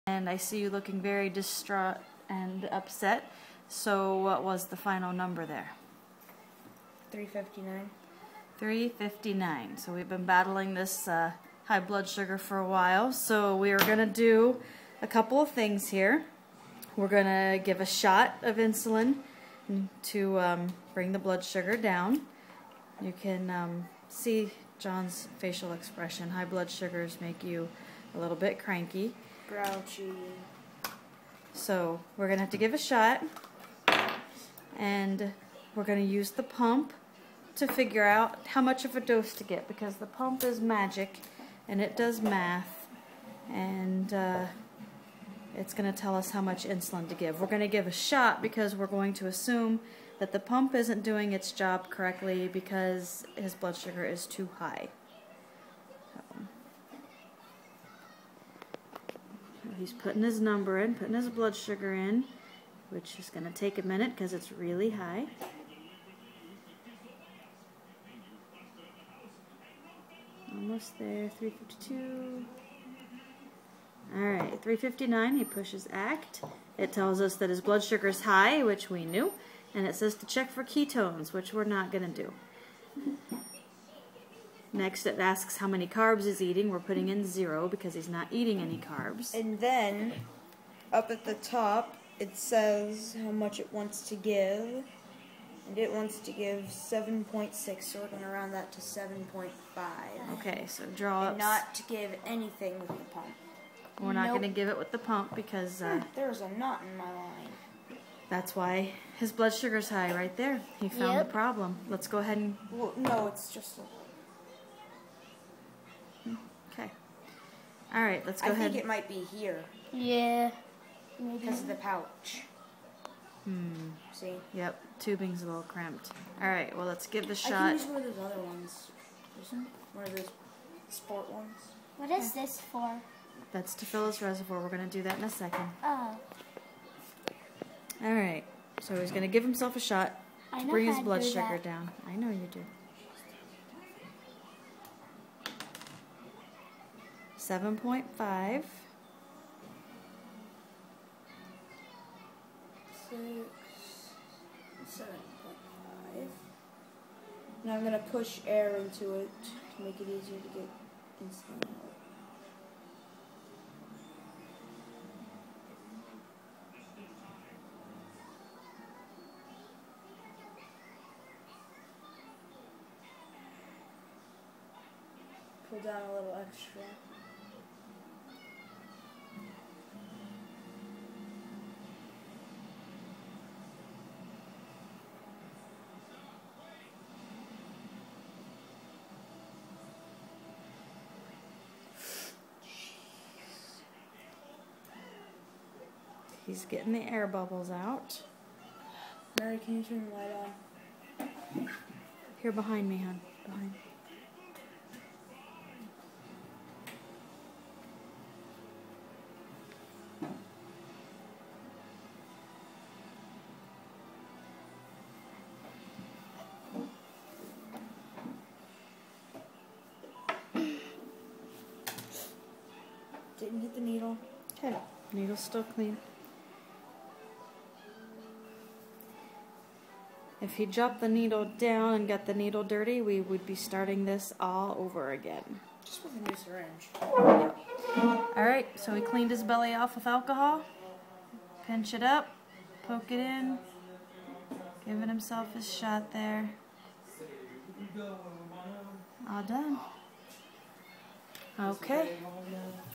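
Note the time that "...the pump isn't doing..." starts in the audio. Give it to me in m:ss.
0:50.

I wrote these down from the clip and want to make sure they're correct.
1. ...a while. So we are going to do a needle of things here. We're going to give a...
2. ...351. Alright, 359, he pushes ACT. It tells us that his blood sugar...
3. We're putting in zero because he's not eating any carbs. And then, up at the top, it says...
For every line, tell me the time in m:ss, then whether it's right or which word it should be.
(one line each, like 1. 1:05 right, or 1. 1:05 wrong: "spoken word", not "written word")
1. 0:12 wrong: "couple", not "needle"
2. 1:11 wrong: "352", not "351"
3. 1:26 right.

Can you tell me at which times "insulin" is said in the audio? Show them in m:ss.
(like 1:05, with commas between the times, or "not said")
0:18, 0:46.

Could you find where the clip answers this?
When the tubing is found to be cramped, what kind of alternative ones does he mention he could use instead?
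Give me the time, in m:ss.
2:10.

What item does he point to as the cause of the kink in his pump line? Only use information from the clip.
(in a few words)
the pouch.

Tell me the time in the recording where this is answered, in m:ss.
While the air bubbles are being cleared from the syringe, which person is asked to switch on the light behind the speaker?
3:19.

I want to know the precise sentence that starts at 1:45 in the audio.
Uh, There's a knot in my line.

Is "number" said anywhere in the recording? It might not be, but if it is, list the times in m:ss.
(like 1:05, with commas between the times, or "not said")
0:05, 1:00.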